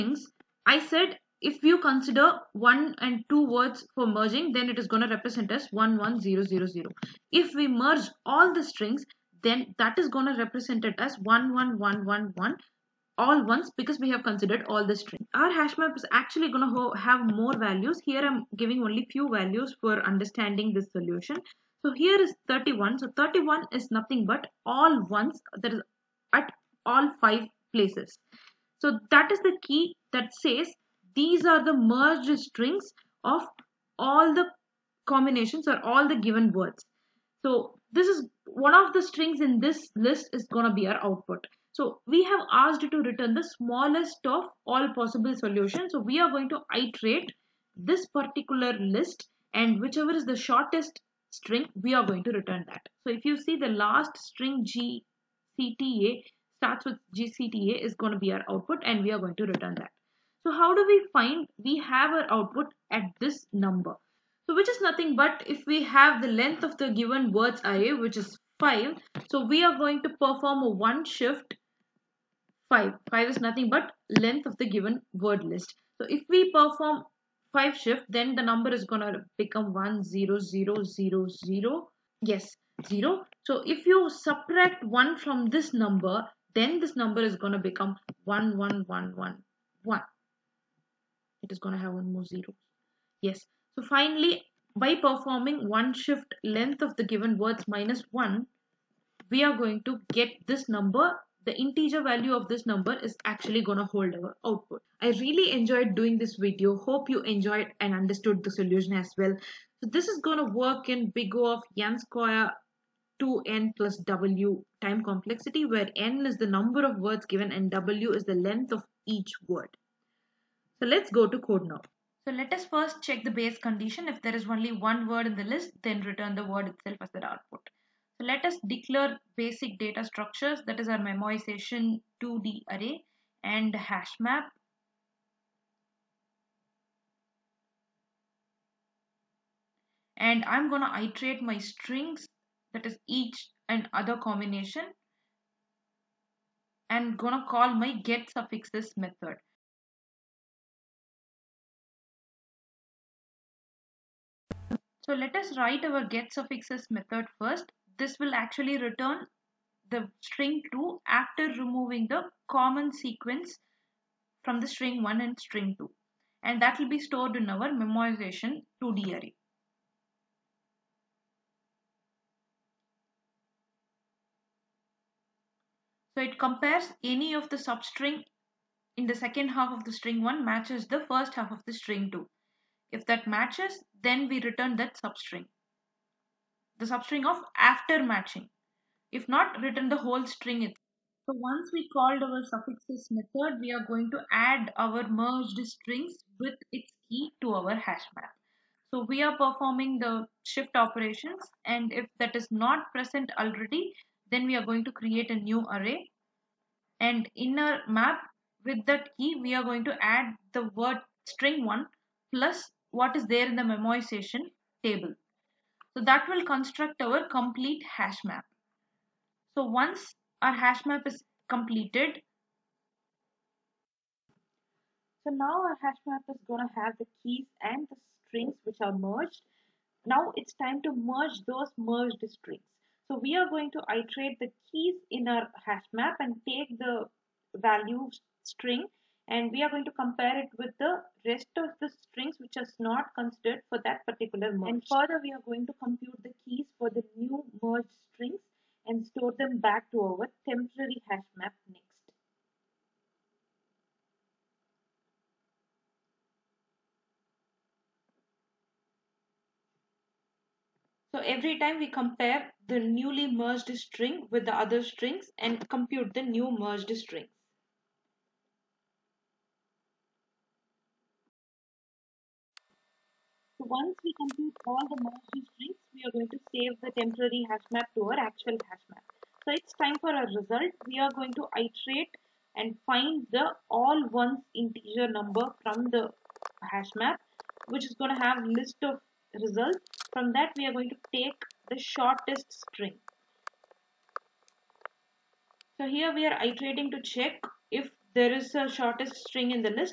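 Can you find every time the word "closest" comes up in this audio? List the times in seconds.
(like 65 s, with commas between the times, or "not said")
not said.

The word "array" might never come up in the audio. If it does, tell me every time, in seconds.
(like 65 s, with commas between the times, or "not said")
67 s, 132 s, 169 s, 205 s.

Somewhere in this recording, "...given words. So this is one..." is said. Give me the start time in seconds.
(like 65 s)
36 s.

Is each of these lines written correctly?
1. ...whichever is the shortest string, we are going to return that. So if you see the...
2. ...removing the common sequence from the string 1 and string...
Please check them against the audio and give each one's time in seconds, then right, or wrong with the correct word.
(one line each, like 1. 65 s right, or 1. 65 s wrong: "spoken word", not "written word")
1. 49 s right
2. 161 s right.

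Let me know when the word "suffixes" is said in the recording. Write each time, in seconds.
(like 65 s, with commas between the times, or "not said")
148 s, 156 s, 192 s.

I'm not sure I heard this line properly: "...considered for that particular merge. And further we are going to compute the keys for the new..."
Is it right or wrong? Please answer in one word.
right.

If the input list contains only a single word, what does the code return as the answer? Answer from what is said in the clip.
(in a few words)
the word itself.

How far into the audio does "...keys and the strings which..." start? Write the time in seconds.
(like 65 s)
227 s.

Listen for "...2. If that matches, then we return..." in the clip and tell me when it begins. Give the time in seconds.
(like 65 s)
182 s.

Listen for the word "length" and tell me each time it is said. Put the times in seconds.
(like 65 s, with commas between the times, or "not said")
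66 s, 74 s, 96 s, 118 s.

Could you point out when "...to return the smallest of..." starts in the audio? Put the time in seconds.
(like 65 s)
42 s.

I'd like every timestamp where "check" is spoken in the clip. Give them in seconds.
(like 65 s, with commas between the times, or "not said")
123 s, 297 s.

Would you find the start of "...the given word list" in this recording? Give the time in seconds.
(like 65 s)
74 s.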